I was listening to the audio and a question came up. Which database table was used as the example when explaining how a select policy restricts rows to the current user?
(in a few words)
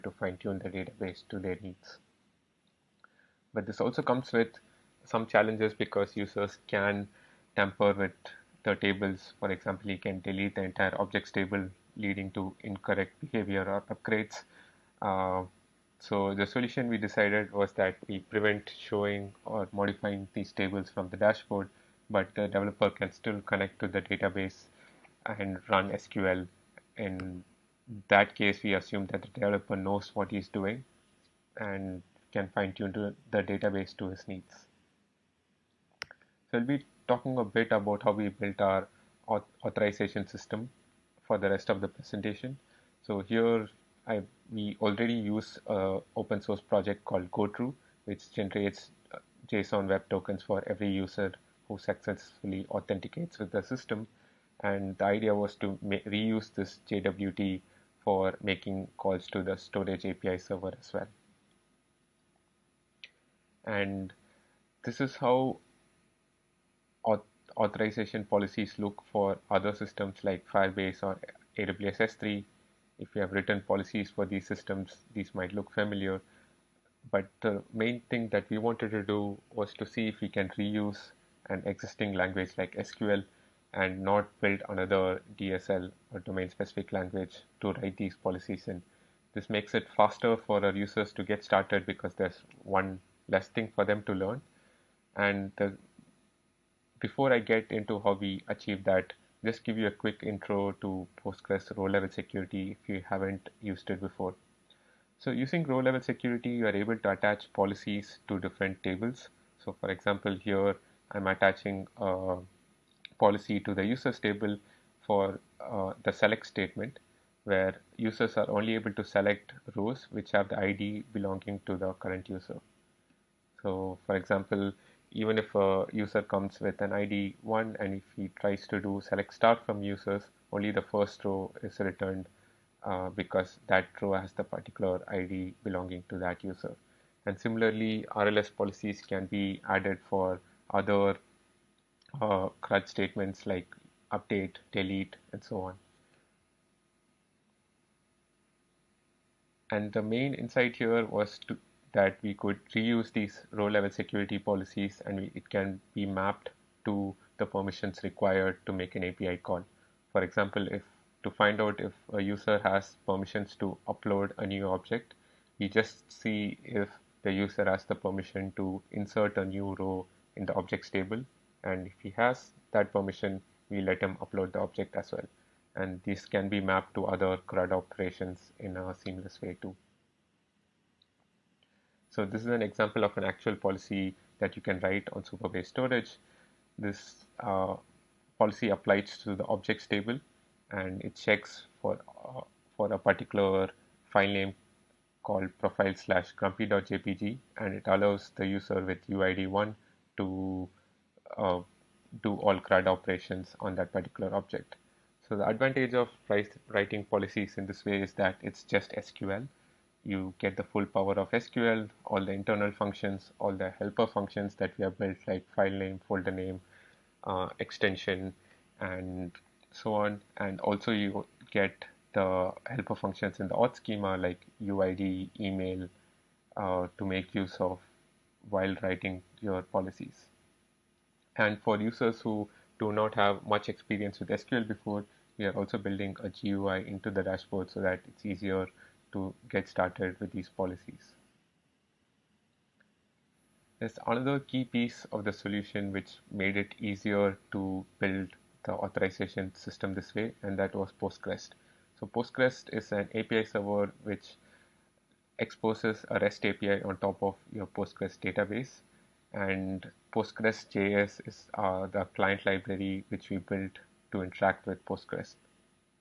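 users table.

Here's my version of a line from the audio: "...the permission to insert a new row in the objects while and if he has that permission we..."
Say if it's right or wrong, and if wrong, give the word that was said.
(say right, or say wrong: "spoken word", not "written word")
wrong: "table", not "while".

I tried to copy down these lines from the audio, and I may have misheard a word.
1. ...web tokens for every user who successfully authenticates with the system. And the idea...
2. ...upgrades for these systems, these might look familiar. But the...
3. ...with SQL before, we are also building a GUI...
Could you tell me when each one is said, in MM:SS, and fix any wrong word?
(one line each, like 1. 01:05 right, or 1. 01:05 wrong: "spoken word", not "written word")
1. 00:49 right
2. 01:13 wrong: "policies", not "upgrades"
3. 03:54 right.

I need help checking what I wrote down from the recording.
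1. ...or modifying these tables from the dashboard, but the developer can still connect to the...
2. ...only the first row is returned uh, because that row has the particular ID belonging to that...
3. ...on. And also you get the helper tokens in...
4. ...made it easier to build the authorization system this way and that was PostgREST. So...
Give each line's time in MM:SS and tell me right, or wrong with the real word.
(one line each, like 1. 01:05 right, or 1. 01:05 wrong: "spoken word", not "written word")
1. 00:19 right
2. 02:10 right
3. 03:39 wrong: "functions", not "tokens"
4. 04:06 right.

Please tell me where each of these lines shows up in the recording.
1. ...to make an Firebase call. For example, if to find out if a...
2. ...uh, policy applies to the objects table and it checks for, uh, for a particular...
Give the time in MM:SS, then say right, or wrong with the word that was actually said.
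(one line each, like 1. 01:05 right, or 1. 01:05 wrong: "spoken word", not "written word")
1. 02:38 wrong: "API", not "Firebase"
2. 03:07 right.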